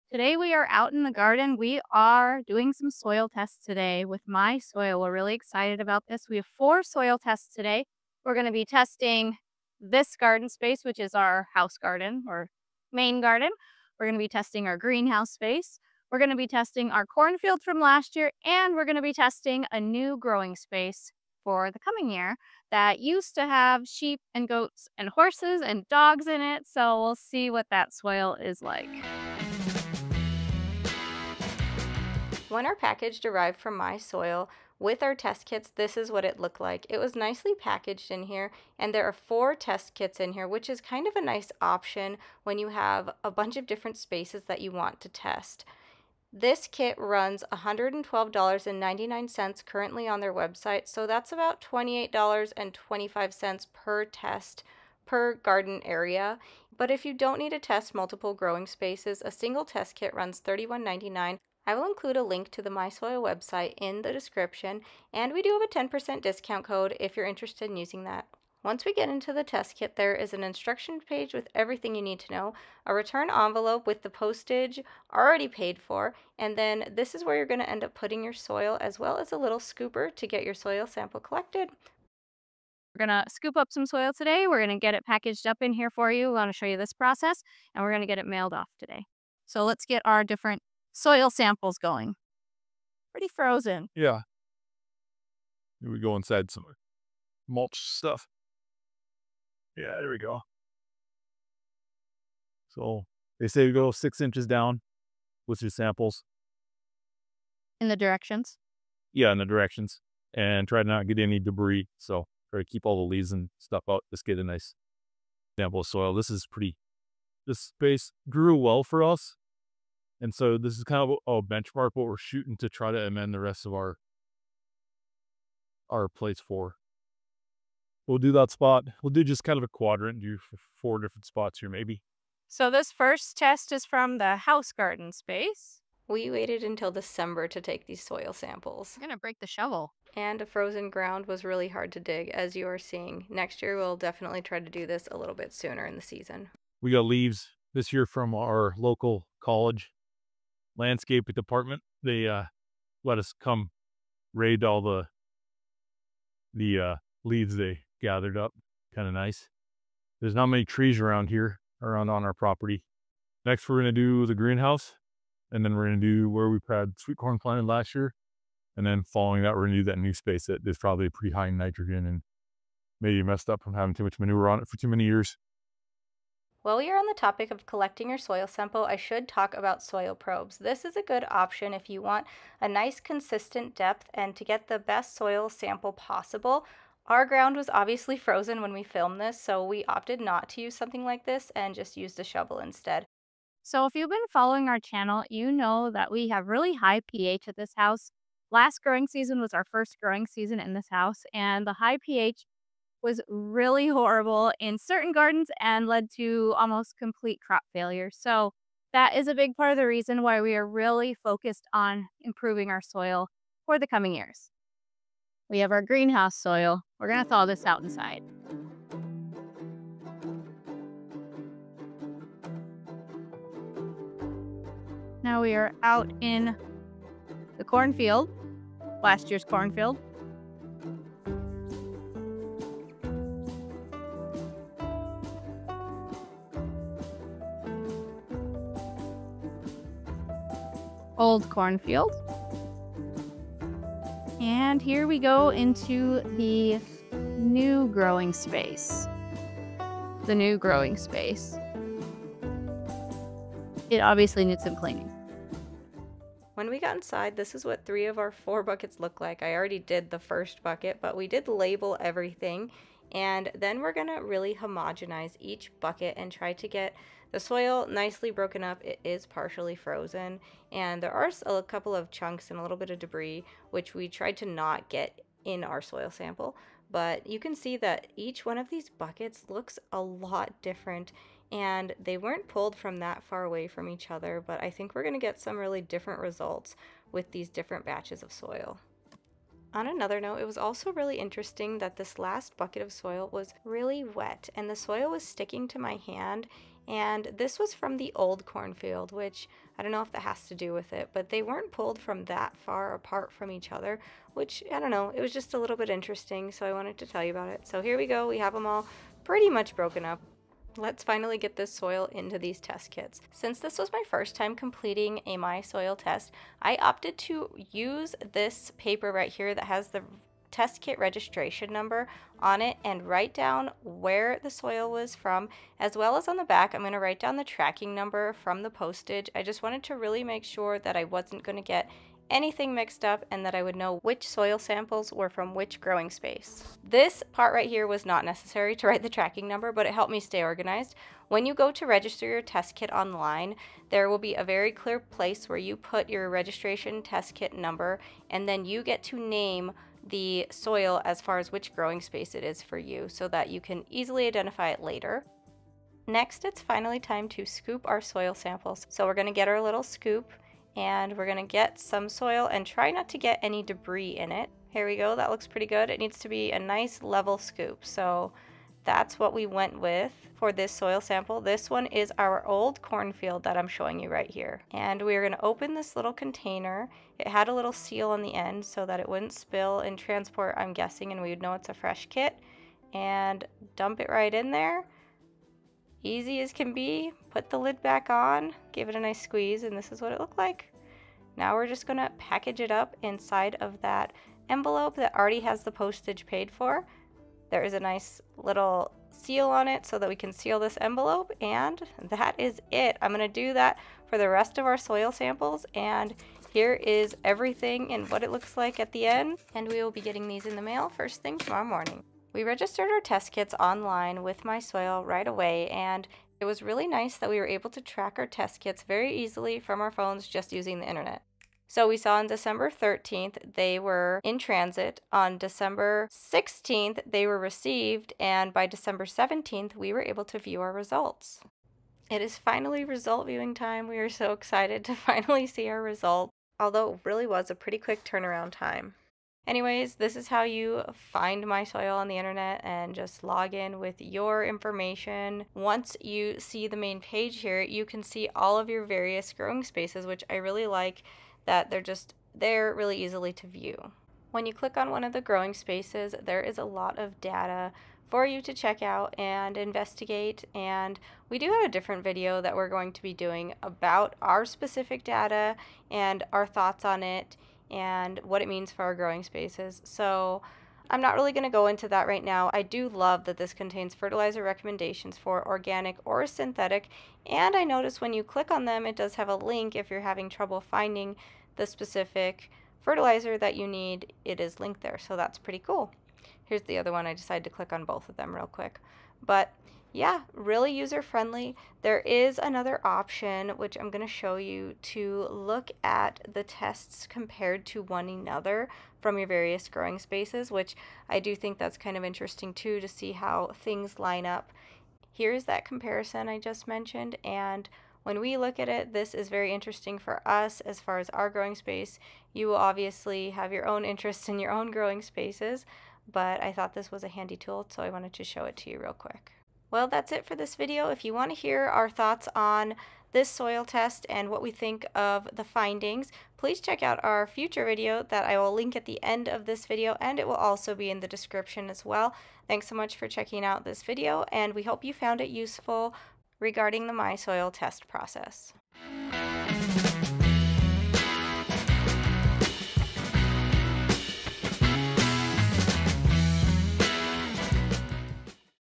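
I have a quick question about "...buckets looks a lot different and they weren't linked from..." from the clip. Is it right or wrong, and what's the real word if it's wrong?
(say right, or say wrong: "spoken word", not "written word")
wrong: "pulled", not "linked".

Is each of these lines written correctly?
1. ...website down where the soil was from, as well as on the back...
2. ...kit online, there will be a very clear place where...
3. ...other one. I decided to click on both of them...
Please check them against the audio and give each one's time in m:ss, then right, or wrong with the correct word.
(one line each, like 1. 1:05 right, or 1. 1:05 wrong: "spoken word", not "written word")
1. 5:23 wrong: "write", not "website"
2. 5:42 right
3. 8:06 right.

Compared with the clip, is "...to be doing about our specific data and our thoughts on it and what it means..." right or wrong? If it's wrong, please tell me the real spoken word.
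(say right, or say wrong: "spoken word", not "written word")
right.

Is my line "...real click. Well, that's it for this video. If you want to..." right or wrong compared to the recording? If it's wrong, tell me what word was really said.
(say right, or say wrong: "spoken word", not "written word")
wrong: "quick", not "click".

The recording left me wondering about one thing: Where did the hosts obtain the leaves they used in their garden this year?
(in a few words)
local college landscape department.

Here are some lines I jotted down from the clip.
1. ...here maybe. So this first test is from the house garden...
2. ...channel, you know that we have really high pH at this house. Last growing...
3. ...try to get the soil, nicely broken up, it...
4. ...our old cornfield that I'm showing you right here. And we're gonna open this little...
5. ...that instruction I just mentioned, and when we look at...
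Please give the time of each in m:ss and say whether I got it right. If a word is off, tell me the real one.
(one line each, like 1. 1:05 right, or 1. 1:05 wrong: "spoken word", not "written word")
1. 2:11 right
2. 3:14 right
3. 4:26 right
4. 6:12 right
5. 8:25 wrong: "comparison", not "instruction".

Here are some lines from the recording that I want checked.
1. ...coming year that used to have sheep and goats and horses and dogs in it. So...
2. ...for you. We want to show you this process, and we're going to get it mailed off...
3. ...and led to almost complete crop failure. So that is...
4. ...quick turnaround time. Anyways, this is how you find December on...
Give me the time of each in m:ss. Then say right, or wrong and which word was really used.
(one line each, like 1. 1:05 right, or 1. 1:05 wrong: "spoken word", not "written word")
1. 0:21 right
2. 1:25 right
3. 3:25 right
4. 7:17 wrong: "MySoil", not "December".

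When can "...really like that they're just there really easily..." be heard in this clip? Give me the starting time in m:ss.
7:30.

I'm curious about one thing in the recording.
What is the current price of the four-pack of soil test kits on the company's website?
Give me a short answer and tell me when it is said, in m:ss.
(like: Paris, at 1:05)
$112.99, at 0:47.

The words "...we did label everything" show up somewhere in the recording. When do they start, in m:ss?
4:21.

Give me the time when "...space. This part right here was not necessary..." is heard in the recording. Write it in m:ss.
5:36.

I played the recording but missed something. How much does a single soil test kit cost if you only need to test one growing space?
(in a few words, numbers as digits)
$31.99.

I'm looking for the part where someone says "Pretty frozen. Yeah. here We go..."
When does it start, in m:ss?
1:33.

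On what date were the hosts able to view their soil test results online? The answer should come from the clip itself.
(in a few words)
December 17.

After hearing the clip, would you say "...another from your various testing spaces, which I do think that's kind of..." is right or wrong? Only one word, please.
wrong.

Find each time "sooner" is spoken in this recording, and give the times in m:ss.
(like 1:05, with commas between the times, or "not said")
2:25.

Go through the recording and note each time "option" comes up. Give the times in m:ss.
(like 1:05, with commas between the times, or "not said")
0:41, 3:01, 8:12.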